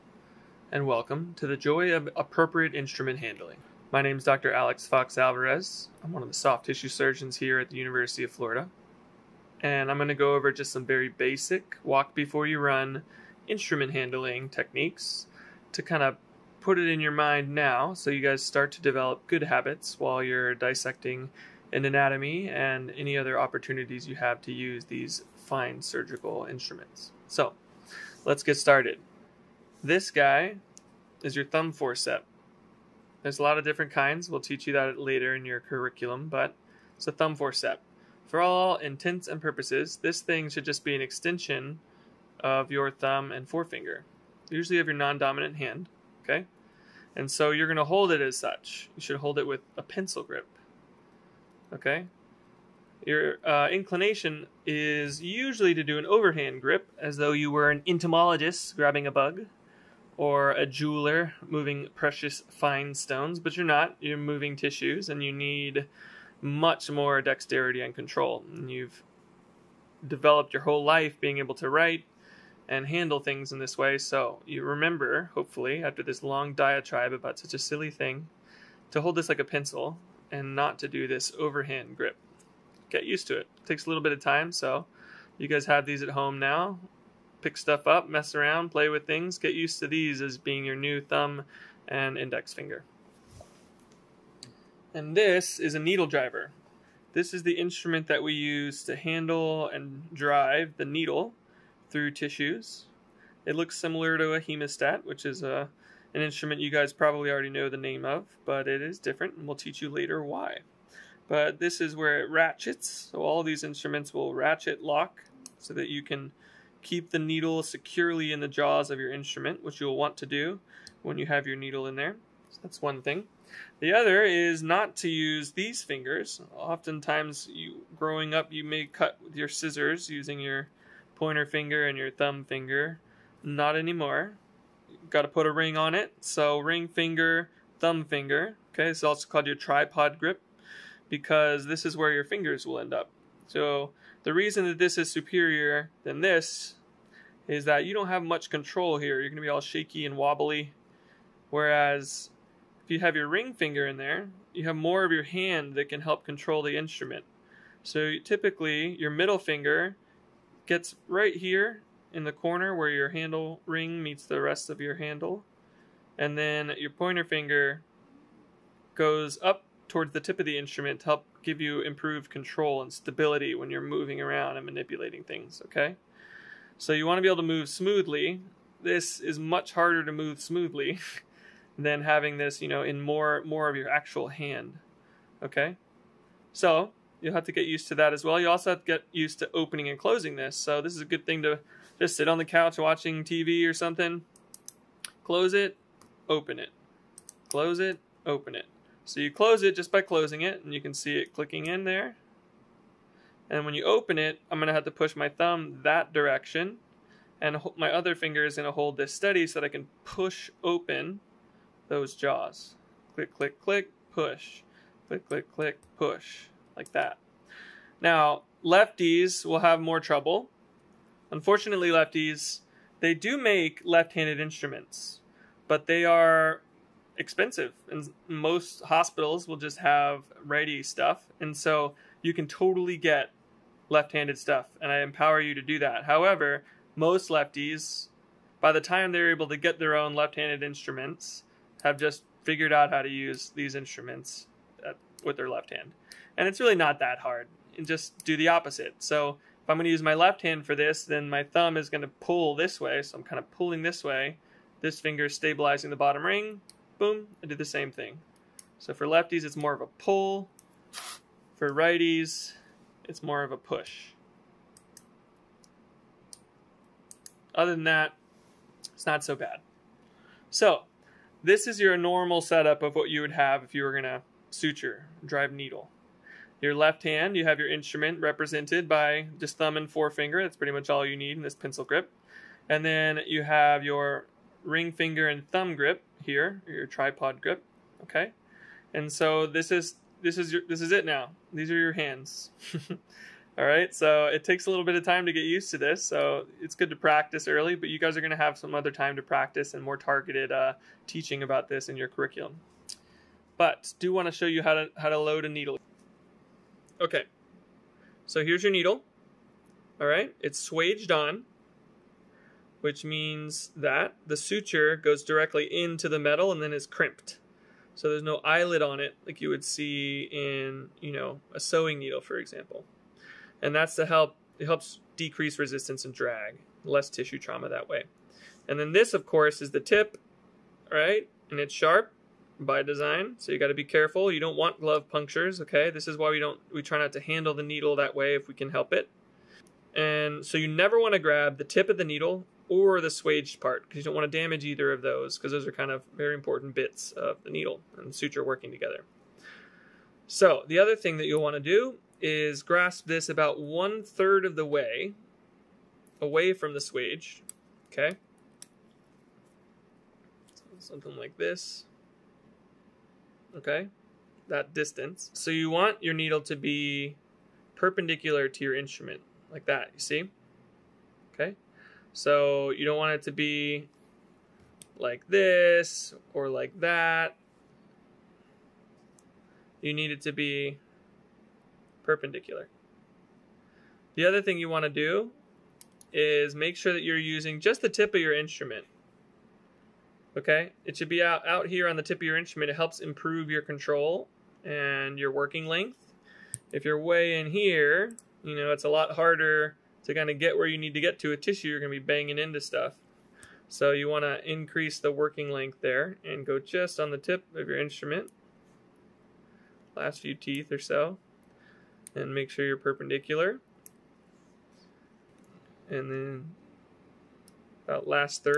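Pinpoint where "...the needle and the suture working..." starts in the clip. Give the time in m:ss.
5:47.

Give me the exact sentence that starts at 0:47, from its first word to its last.
And so you're going to hold it as such.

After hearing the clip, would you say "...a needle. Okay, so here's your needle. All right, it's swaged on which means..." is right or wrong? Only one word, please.
right.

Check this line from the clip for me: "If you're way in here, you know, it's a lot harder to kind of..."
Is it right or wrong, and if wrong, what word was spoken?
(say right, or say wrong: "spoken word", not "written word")
right.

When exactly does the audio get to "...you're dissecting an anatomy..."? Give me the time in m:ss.
0:20.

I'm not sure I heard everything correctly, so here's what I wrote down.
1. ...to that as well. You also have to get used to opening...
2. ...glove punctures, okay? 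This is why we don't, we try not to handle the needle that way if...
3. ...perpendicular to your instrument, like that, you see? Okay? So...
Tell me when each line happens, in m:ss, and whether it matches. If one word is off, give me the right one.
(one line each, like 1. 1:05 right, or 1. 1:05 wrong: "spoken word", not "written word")
1. 3:07 right
2. 5:34 right
3. 6:07 right.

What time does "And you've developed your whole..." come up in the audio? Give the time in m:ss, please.
1:08.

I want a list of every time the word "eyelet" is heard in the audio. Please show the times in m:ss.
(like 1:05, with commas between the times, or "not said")
5:18.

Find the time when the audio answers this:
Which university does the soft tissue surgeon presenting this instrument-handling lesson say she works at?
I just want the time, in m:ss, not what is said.
0:07.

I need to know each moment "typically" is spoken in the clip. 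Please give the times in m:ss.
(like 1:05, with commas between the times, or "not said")
2:38.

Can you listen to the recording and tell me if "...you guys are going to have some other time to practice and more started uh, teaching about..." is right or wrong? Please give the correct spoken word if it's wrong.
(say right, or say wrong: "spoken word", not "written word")
wrong: "targeted", not "started".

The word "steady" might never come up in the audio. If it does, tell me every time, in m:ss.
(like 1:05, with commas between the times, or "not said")
3:29.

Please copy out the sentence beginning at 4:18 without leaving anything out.
So for lefties, it's more of a pull.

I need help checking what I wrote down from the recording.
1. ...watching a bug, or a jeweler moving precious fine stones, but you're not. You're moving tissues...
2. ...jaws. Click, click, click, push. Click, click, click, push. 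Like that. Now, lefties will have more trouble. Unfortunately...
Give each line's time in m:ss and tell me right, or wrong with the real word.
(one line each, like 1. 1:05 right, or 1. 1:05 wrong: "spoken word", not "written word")
1. 0:58 wrong: "grabbing", not "watching"
2. 3:32 right.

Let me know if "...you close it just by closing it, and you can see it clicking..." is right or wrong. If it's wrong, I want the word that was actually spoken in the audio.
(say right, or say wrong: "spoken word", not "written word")
right.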